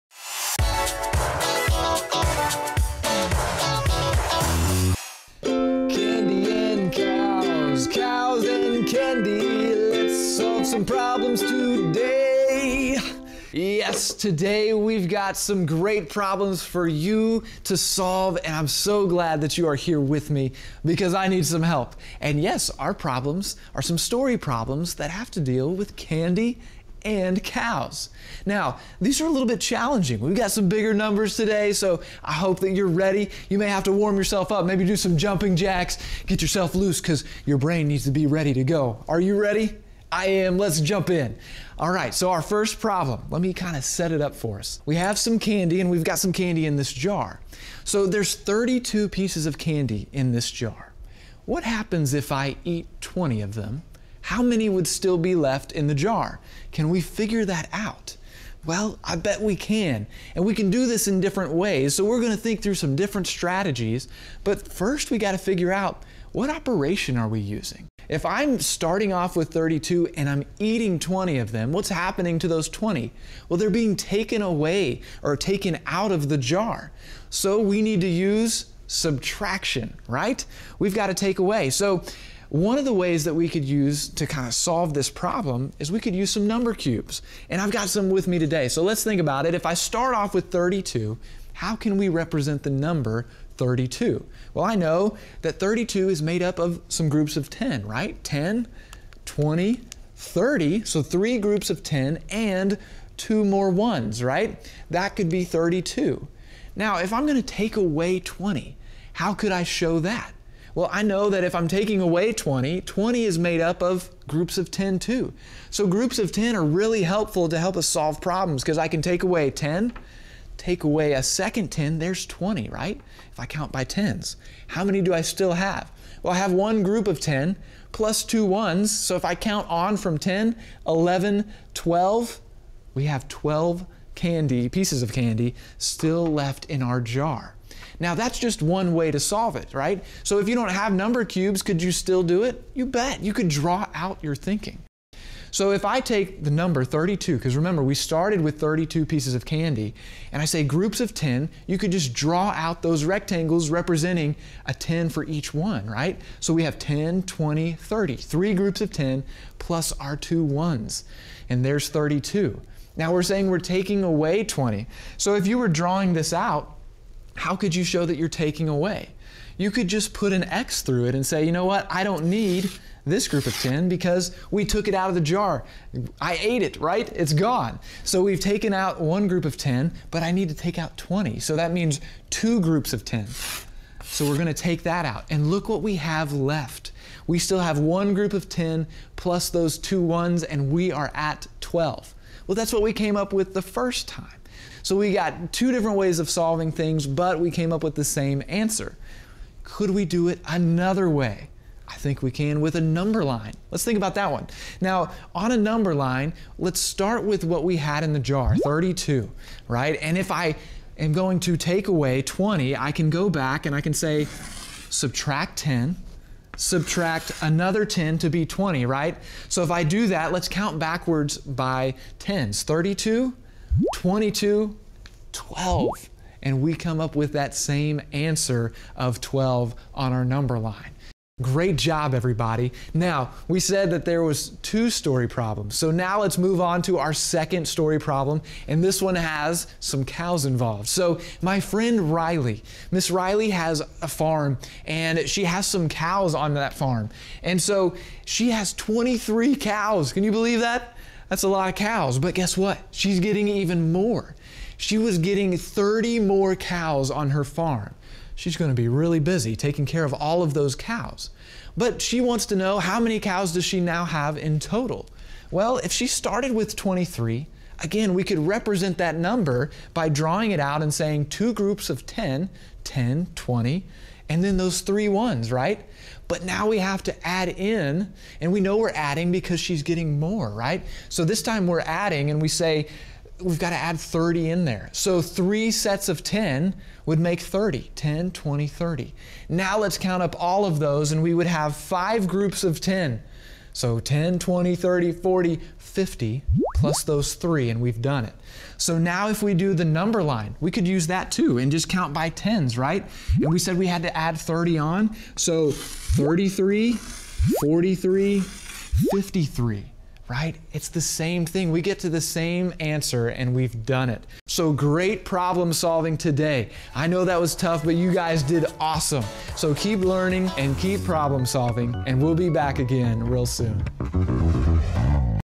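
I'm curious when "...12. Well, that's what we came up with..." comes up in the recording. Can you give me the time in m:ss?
3:11.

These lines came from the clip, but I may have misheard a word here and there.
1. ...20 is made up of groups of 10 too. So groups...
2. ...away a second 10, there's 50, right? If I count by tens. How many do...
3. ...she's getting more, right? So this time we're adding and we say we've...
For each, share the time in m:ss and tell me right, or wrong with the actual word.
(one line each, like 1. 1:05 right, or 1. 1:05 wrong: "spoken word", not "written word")
1. 1:52 right
2. 2:00 wrong: "20", not "50"
3. 4:39 right.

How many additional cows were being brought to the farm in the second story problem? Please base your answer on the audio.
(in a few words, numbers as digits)
30.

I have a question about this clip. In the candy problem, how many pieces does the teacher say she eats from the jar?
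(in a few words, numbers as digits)
20.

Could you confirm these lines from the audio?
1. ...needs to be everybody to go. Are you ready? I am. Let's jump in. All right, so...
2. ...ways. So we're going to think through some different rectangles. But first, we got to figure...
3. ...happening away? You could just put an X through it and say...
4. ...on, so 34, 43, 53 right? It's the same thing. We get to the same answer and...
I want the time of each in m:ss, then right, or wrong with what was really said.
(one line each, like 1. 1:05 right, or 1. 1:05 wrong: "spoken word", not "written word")
1. 0:37 wrong: "ready", not "everybody"
2. 1:01 wrong: "strategies", not "rectangles"
3. 2:48 wrong: "taking", not "happening"
4. 5:04 wrong: "33", not "34".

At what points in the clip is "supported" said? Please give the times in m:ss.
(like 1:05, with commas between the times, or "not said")
not said.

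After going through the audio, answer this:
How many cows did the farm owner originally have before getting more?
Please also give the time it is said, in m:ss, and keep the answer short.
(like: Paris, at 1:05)
23, at 4:08.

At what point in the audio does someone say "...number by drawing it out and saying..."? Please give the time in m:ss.
4:29.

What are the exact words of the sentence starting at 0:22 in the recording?
And yes, our problems are some story problems that have to deal with candy and cows.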